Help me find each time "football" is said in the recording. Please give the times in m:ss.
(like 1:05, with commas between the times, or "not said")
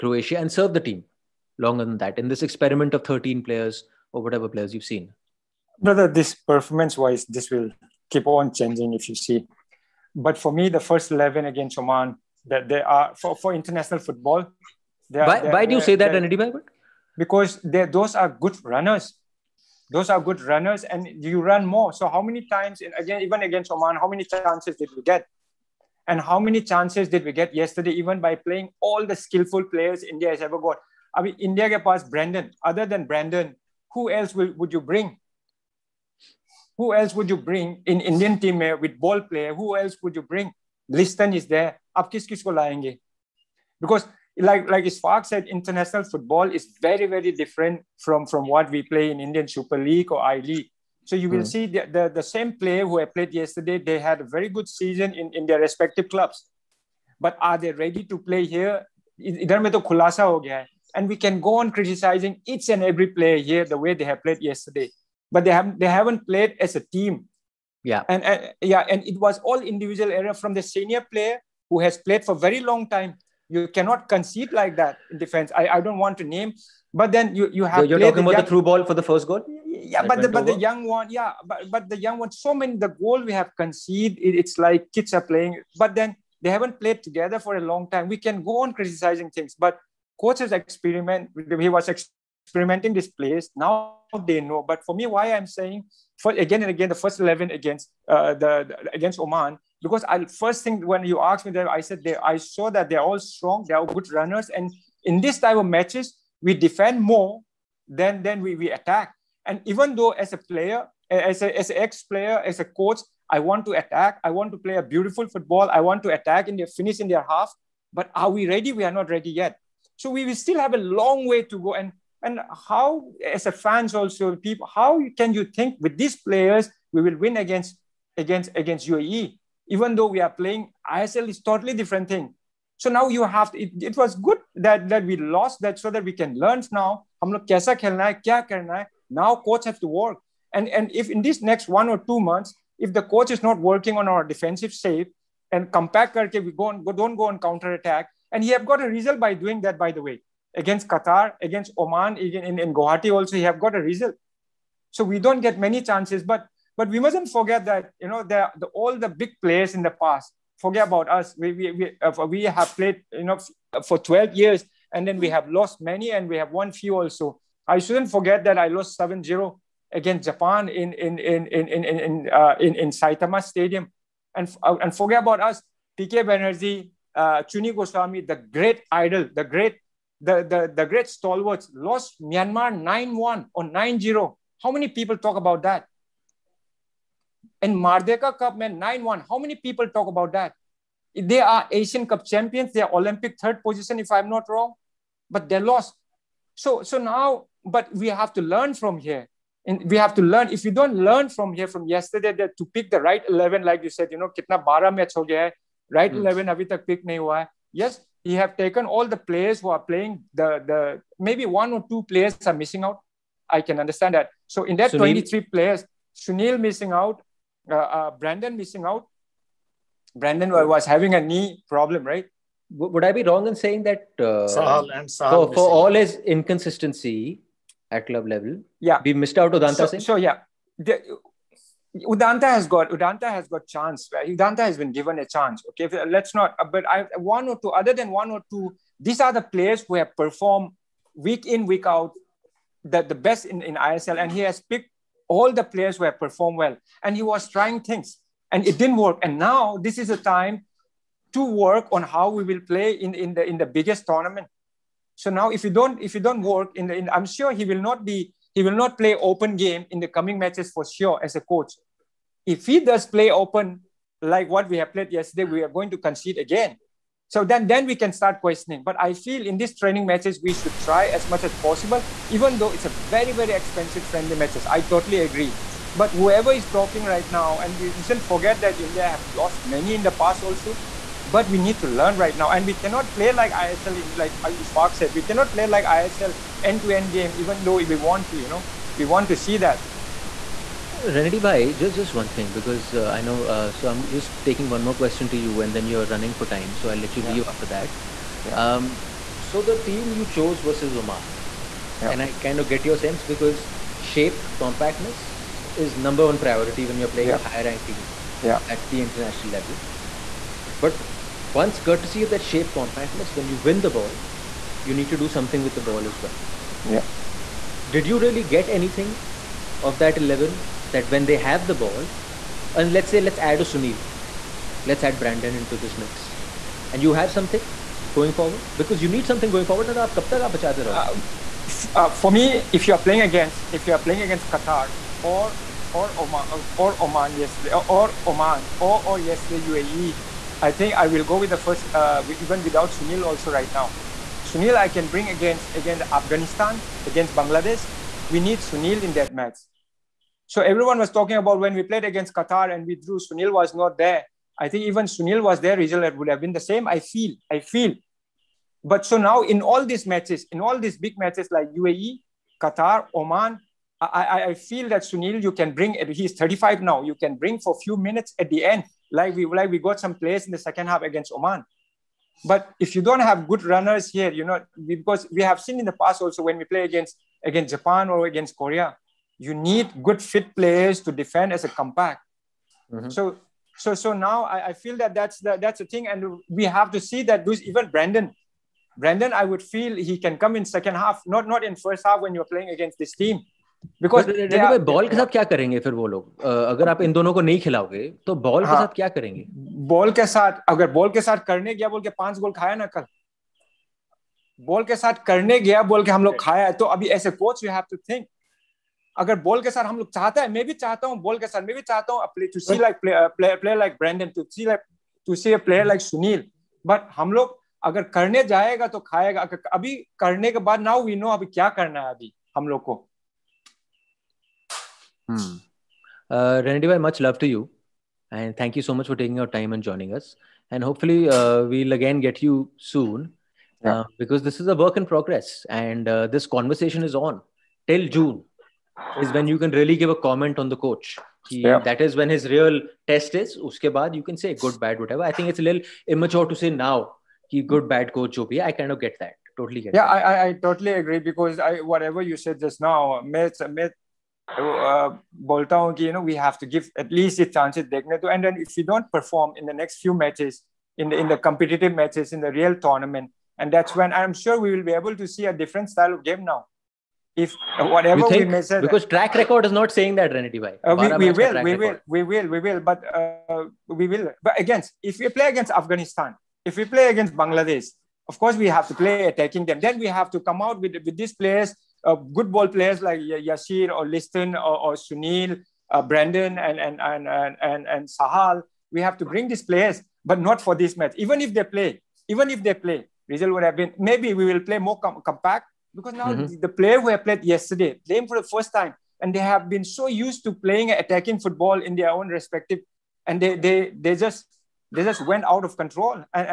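0:13, 0:46, 1:55, 8:21.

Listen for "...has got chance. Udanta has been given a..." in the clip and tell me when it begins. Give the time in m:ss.
3:53.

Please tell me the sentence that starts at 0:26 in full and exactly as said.
And how many chances did we get yesterday, even by playing all the skillful players India has ever got?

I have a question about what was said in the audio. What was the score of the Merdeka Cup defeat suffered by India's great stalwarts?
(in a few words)
9-1.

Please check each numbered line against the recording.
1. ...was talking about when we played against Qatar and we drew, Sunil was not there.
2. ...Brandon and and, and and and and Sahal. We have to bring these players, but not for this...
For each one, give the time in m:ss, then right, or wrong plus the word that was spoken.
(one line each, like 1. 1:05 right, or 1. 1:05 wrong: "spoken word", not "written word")
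1. 5:50 right
2. 8:06 right.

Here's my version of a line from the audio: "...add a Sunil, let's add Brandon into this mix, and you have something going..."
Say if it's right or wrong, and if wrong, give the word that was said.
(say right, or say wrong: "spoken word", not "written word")
right.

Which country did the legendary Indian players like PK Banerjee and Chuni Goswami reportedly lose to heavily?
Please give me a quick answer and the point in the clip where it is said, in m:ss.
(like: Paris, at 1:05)
Myanmar, at 3:02.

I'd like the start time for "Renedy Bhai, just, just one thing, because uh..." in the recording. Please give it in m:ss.
4:51.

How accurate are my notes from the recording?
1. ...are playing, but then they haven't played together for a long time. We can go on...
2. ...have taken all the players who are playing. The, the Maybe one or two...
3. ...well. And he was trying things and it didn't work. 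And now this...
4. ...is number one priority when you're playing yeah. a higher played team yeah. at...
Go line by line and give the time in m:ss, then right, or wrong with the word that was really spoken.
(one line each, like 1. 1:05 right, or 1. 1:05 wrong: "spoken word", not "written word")
1. 1:25 right
2. 3:28 right
3. 4:06 right
4. 5:05 wrong: "ranked", not "played".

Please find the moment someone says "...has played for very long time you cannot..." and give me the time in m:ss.
1:11.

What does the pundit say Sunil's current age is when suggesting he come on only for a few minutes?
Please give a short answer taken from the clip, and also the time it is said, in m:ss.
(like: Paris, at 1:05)
35, at 6:06.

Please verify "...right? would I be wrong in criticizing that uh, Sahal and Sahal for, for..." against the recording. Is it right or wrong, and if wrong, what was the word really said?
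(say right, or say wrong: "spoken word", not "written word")
wrong: "saying", not "criticizing".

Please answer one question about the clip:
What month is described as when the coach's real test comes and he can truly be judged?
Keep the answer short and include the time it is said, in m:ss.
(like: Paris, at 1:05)
June, at 7:18.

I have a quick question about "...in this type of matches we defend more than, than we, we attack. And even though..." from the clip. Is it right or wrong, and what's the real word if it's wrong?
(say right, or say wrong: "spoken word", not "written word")
right.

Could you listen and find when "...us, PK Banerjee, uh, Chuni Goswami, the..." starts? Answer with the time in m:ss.
2:55.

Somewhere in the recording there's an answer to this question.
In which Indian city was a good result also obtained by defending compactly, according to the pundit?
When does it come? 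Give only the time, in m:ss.
2:32.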